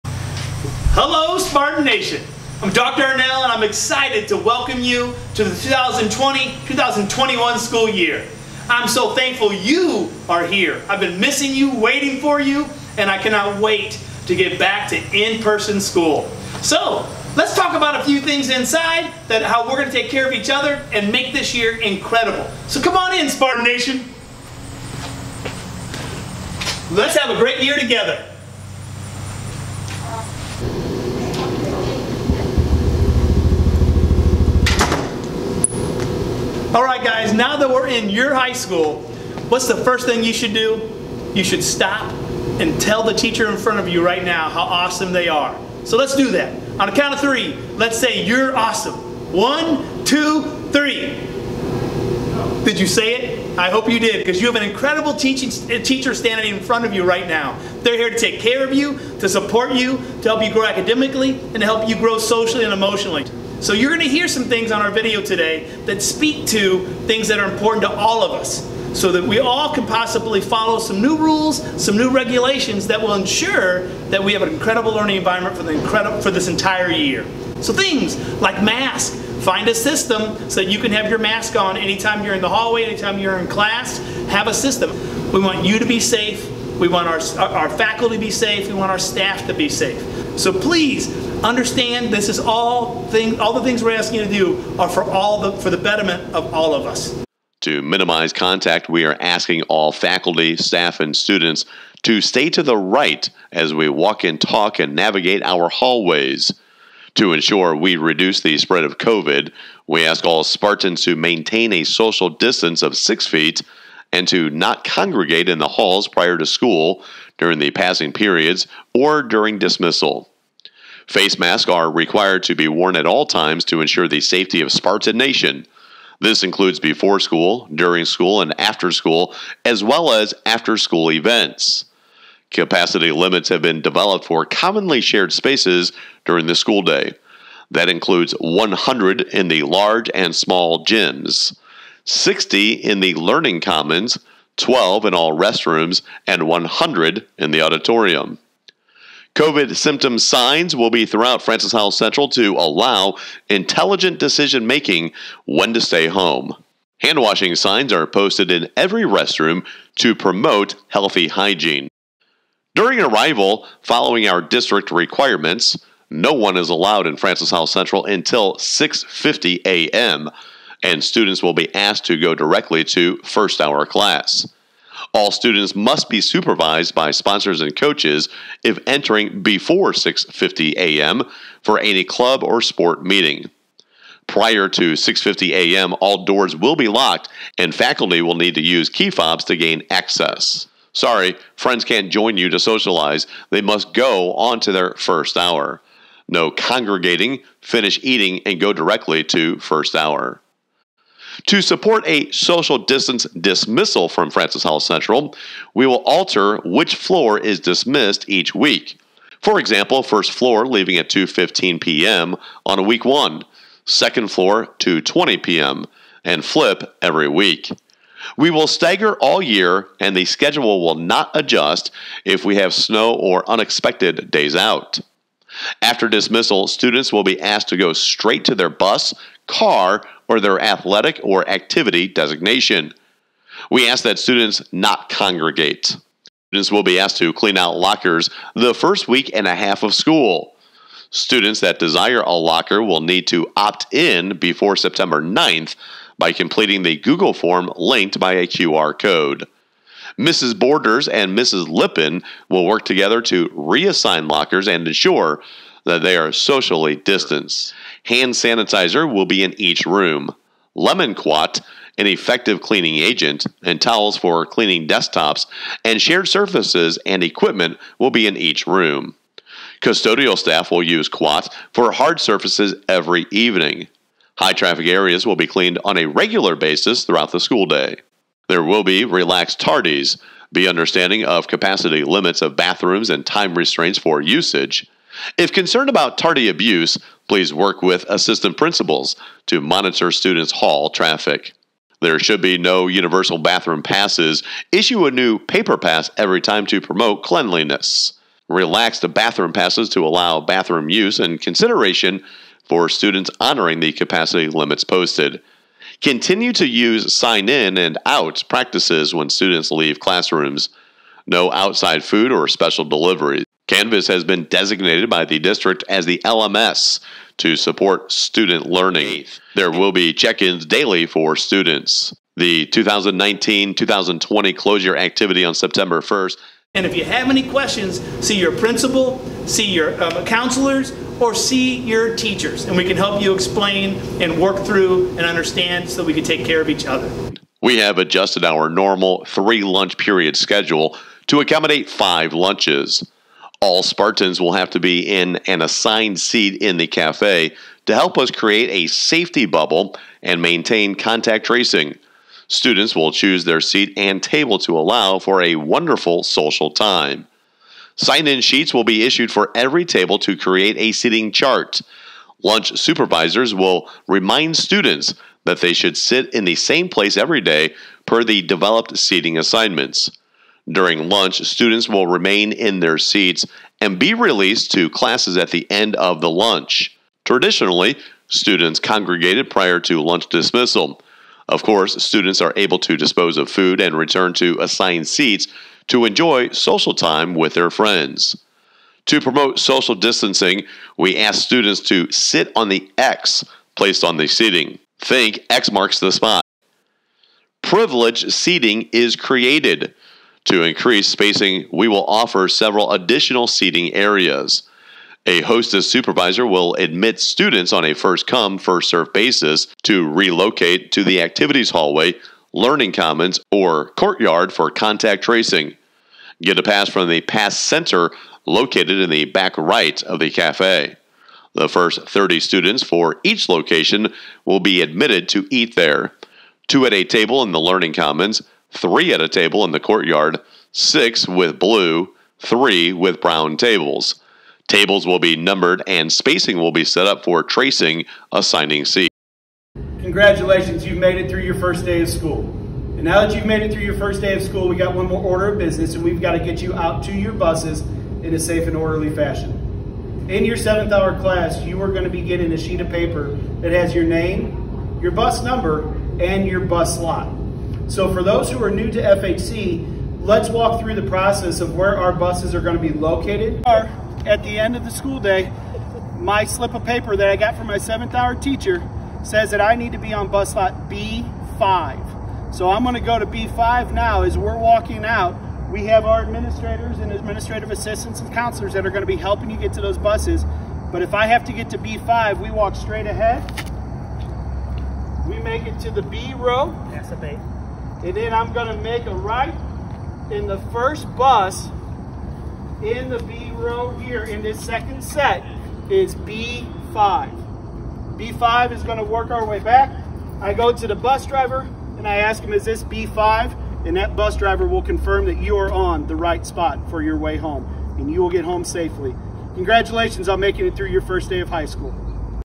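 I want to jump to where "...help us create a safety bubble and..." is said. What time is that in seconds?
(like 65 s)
347 s.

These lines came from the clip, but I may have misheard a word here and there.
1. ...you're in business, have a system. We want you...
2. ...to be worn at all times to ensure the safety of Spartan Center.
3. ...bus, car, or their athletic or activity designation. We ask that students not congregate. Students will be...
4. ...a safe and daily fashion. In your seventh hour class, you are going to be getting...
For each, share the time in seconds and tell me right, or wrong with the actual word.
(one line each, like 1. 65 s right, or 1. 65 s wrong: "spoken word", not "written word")
1. 83 s wrong: "class", not "business"
2. 122 s wrong: "Nation", not "Center"
3. 228 s right
4. 448 s wrong: "orderly", not "daily".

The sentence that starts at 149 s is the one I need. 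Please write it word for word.
COVID symptom signs will be throughout Francis Howell Central to allow intelligent decision making when to stay home.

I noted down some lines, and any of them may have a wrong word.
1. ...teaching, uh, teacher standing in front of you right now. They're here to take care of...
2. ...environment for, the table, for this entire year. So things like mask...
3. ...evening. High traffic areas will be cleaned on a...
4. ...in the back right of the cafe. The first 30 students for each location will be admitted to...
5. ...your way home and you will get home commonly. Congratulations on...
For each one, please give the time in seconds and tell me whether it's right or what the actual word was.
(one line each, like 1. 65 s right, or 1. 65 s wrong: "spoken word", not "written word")
1. 55 s right
2. 75 s wrong: "incredible", not "table"
3. 273 s right
4. 418 s right
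5. 507 s wrong: "safely", not "commonly".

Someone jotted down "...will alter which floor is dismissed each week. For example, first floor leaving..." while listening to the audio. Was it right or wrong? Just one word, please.
right.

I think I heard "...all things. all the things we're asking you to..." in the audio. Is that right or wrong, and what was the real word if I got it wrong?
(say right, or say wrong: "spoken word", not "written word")
right.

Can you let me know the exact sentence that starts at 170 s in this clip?
and students will be asked to go directly to first hour class.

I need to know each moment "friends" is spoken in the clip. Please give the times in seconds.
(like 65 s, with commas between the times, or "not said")
191 s, 387 s.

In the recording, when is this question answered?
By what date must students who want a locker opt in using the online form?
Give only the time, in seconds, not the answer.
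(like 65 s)
244 s.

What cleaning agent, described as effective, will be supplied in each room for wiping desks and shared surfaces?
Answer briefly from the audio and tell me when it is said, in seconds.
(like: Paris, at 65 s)
Lemon Quat, at 260 s.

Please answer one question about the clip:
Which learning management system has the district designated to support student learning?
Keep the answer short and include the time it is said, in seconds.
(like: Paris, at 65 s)
Canvas, at 313 s.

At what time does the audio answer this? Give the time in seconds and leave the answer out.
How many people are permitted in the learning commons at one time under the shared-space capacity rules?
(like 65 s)
142 s.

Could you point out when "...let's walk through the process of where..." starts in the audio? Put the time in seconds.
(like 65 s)
460 s.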